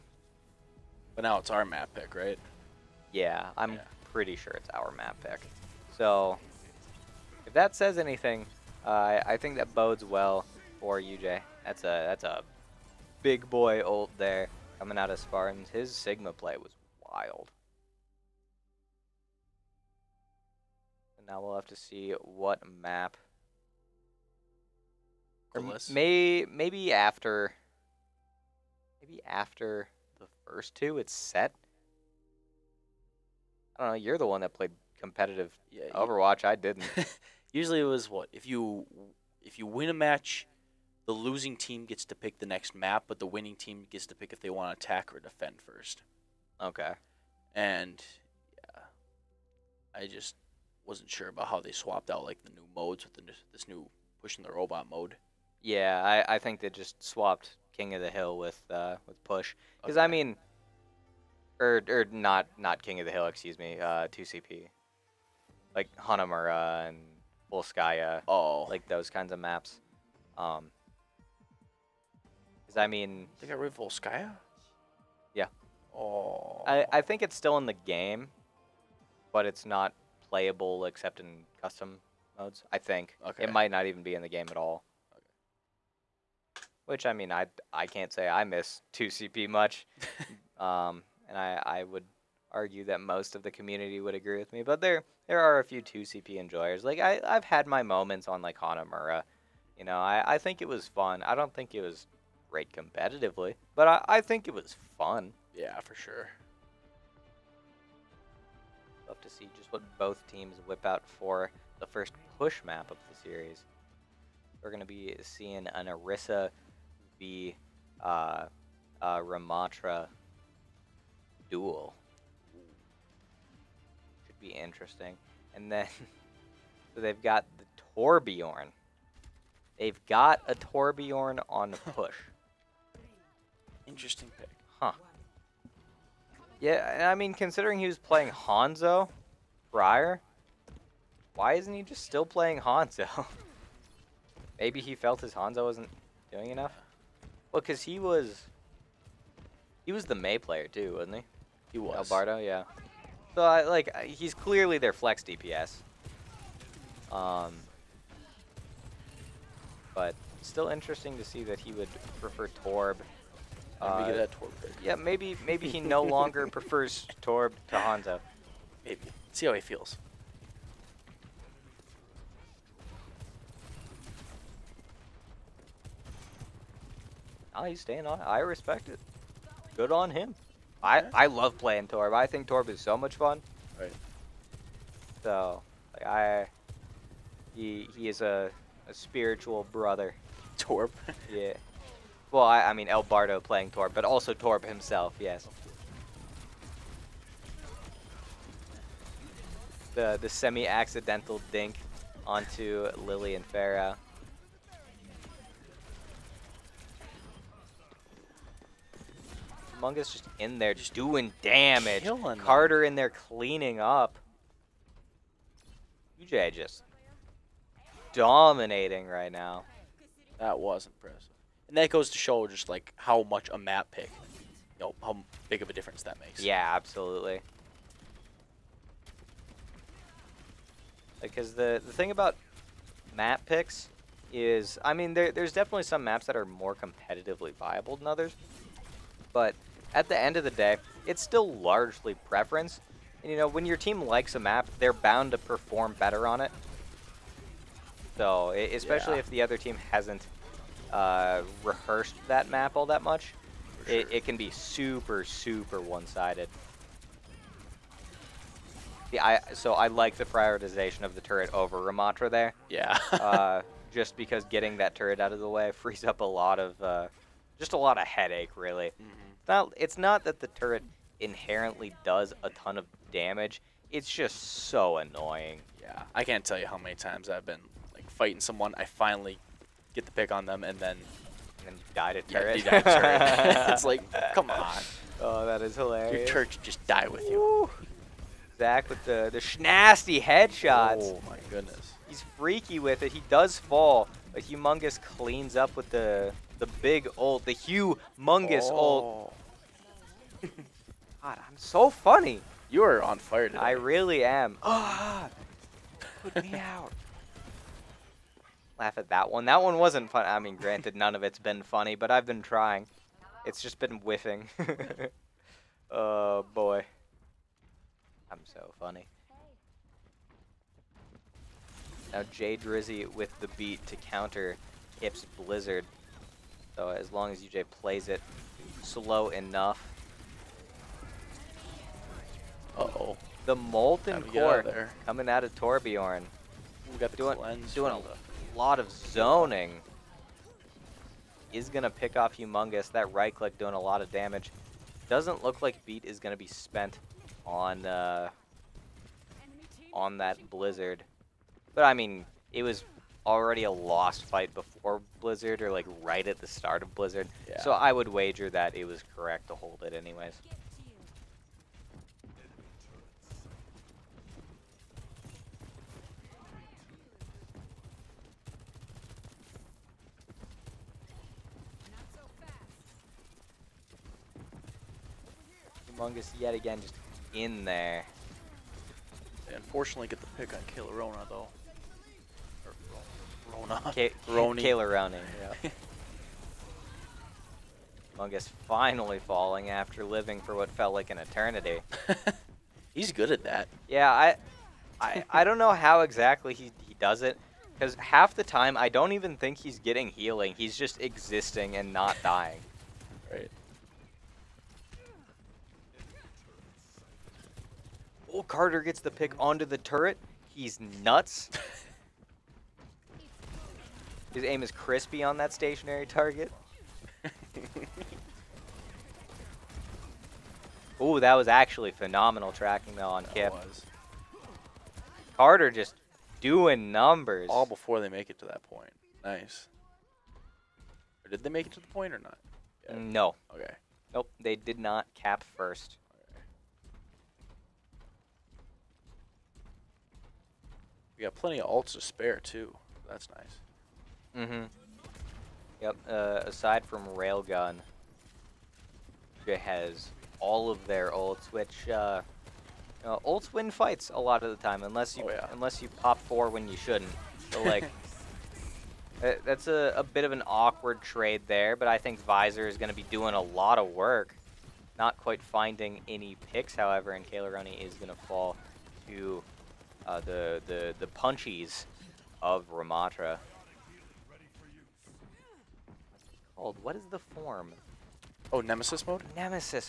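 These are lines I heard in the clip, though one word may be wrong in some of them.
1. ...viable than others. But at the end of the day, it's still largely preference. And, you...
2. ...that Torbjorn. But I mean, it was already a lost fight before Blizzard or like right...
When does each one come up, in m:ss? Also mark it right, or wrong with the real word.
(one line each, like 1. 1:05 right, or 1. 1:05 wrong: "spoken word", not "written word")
1. 3:57 right
2. 5:50 wrong: "Blizzard", not "Torbjorn".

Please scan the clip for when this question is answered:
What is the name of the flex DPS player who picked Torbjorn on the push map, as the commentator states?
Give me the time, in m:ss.
2:32.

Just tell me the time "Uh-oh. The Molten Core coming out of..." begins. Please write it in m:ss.
5:32.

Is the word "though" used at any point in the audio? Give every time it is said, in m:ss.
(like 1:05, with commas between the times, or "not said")
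6:21, 7:02.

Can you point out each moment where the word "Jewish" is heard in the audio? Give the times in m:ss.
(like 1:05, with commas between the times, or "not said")
not said.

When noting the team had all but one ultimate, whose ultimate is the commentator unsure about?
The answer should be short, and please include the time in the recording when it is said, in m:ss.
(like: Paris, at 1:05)
Railgun, at 7:27.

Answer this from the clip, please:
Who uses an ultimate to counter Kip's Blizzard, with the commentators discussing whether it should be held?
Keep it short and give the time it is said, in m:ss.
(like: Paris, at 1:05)
Jay Drizzy, at 5:22.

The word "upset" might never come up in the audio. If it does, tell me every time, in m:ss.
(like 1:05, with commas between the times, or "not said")
not said.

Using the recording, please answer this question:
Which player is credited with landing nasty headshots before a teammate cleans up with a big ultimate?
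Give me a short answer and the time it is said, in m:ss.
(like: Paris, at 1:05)
Zach, at 4:48.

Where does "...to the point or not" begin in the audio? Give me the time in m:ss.
7:11.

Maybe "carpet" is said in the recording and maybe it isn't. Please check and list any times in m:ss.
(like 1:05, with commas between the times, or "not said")
not said.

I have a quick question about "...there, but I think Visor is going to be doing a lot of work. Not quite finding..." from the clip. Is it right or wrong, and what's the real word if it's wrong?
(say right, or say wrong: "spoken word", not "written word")
right.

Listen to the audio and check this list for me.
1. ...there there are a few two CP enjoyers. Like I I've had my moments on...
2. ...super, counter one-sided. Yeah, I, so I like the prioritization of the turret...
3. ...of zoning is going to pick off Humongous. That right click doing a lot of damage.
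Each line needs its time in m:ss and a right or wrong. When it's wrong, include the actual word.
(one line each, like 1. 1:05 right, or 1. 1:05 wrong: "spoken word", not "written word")
1. 1:34 right
2. 4:14 wrong: "super", not "counter"
3. 5:38 right.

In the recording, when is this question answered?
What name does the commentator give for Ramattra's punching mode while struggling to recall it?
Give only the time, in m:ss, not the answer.
7:58.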